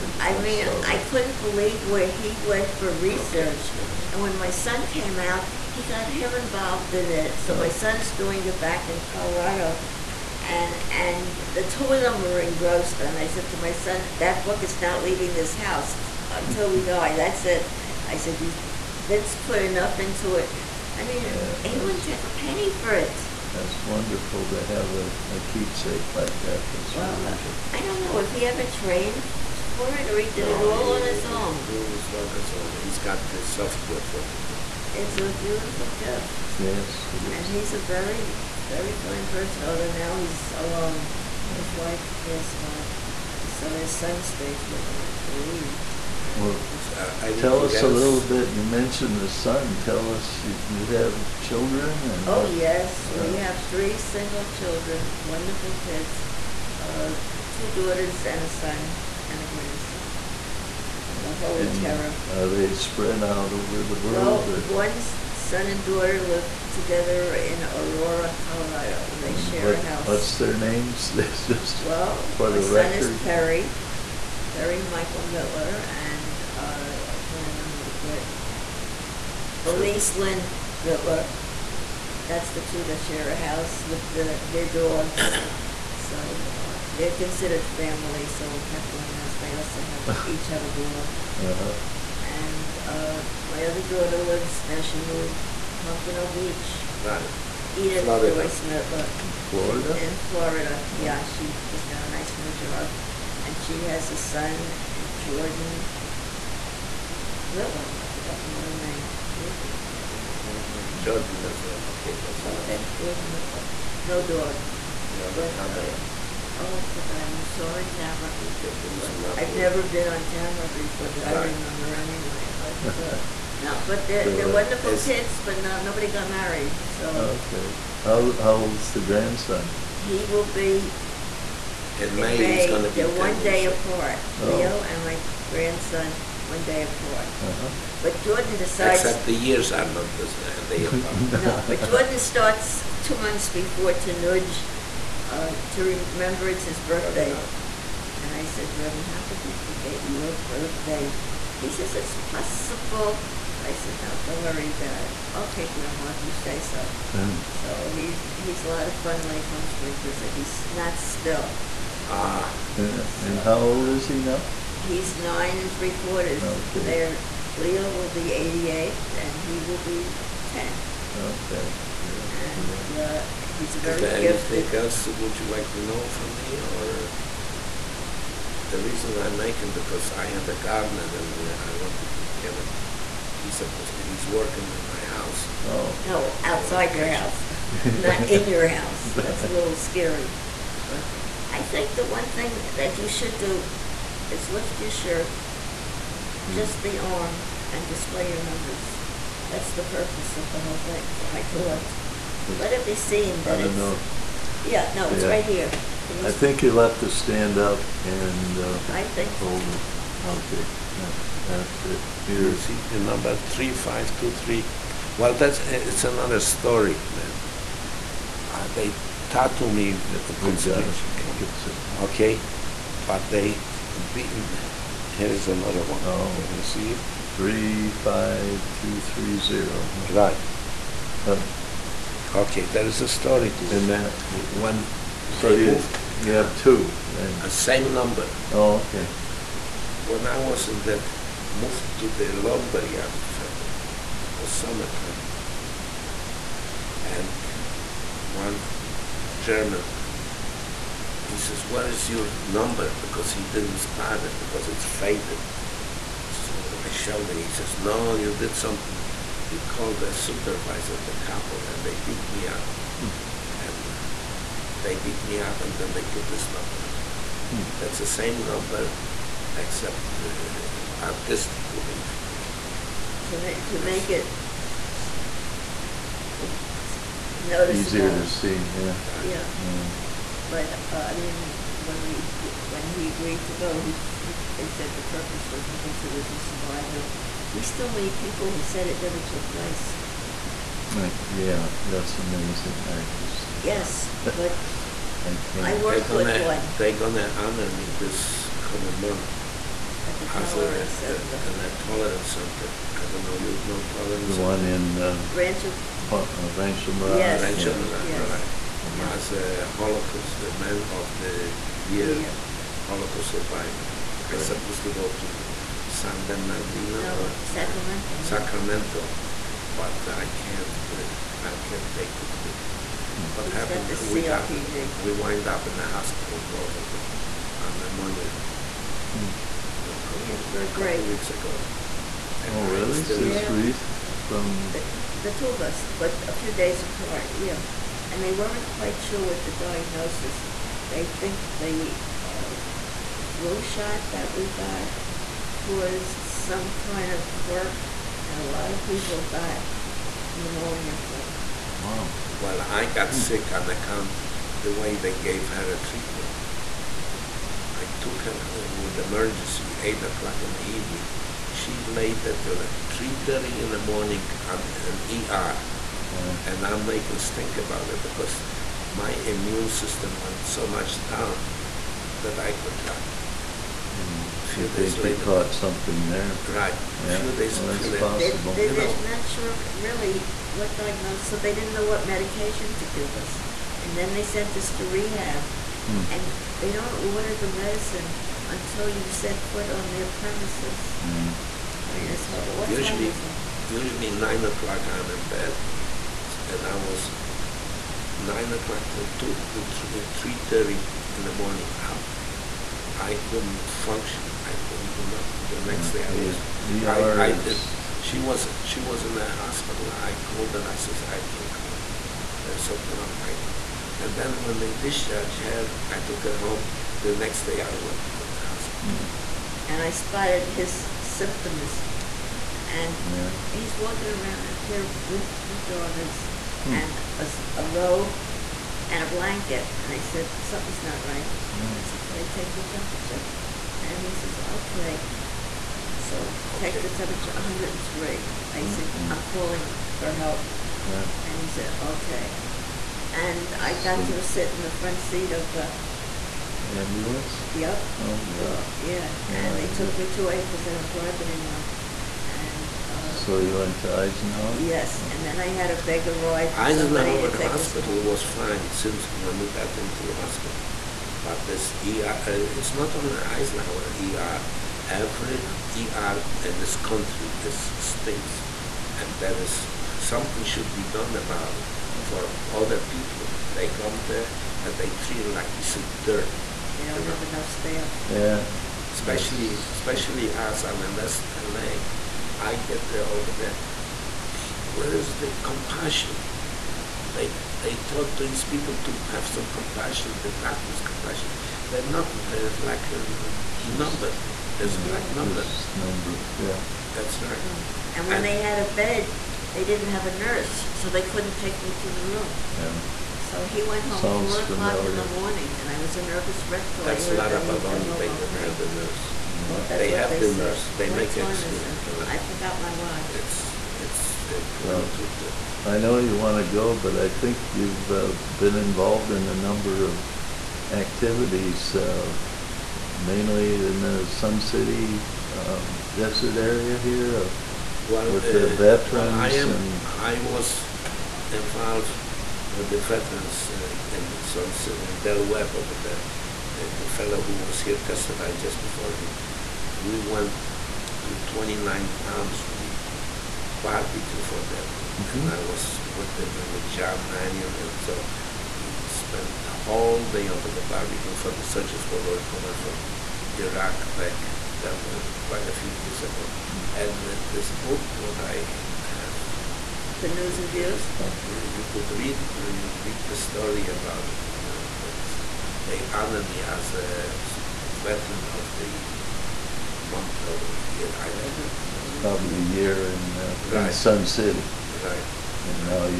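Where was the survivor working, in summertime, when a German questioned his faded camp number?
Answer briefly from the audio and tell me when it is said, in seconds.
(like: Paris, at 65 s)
lumberyard factory, at 242 s.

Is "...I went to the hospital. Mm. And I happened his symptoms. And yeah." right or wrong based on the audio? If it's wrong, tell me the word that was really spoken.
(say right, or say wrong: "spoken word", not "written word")
wrong: "spotted", not "happened".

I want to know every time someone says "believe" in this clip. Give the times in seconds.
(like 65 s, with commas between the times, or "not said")
1 s, 45 s.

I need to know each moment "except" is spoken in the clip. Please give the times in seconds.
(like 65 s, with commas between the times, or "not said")
139 s, 269 s.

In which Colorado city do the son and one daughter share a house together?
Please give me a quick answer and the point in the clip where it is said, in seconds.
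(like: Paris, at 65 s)
Aurora, at 67 s.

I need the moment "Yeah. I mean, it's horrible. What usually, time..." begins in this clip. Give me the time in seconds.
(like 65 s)
391 s.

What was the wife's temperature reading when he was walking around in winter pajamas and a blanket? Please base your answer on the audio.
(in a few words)
103.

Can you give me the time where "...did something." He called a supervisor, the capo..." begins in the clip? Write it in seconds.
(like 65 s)
258 s.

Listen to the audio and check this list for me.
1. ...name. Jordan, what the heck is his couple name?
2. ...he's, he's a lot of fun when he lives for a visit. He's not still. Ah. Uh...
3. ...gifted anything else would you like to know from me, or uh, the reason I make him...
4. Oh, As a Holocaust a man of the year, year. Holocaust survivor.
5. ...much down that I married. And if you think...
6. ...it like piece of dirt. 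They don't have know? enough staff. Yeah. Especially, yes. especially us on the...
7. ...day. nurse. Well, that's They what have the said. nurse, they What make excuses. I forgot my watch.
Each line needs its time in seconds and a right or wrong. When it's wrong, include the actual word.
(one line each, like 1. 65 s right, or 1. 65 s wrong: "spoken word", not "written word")
1. 108 s wrong: "middle", not "couple"
2. 157 s wrong: "comes", not "lives"
3. 174 s right
4. 309 s right
5. 370 s wrong: "contracted", not "married"
6. 475 s right
7. 508 s right.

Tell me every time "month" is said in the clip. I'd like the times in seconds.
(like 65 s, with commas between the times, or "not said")
143 s, 298 s, 569 s.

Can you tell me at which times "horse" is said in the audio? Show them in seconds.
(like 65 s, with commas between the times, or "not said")
not said.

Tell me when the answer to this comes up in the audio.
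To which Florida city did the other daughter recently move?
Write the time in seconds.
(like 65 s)
95 s.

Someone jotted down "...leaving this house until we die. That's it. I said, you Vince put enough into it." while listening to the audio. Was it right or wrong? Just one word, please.
right.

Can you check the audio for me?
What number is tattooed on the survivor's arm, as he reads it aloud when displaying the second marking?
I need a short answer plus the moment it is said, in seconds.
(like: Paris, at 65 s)
35230, at 227 s.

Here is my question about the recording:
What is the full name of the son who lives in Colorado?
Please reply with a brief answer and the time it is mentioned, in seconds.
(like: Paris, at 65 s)
Perry Michael Mittler, at 74 s.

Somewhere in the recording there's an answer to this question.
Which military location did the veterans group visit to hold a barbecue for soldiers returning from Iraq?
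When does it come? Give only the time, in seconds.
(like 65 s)
541 s.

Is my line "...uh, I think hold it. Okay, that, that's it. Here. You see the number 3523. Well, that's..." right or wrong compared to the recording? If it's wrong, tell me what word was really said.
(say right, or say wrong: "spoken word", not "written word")
right.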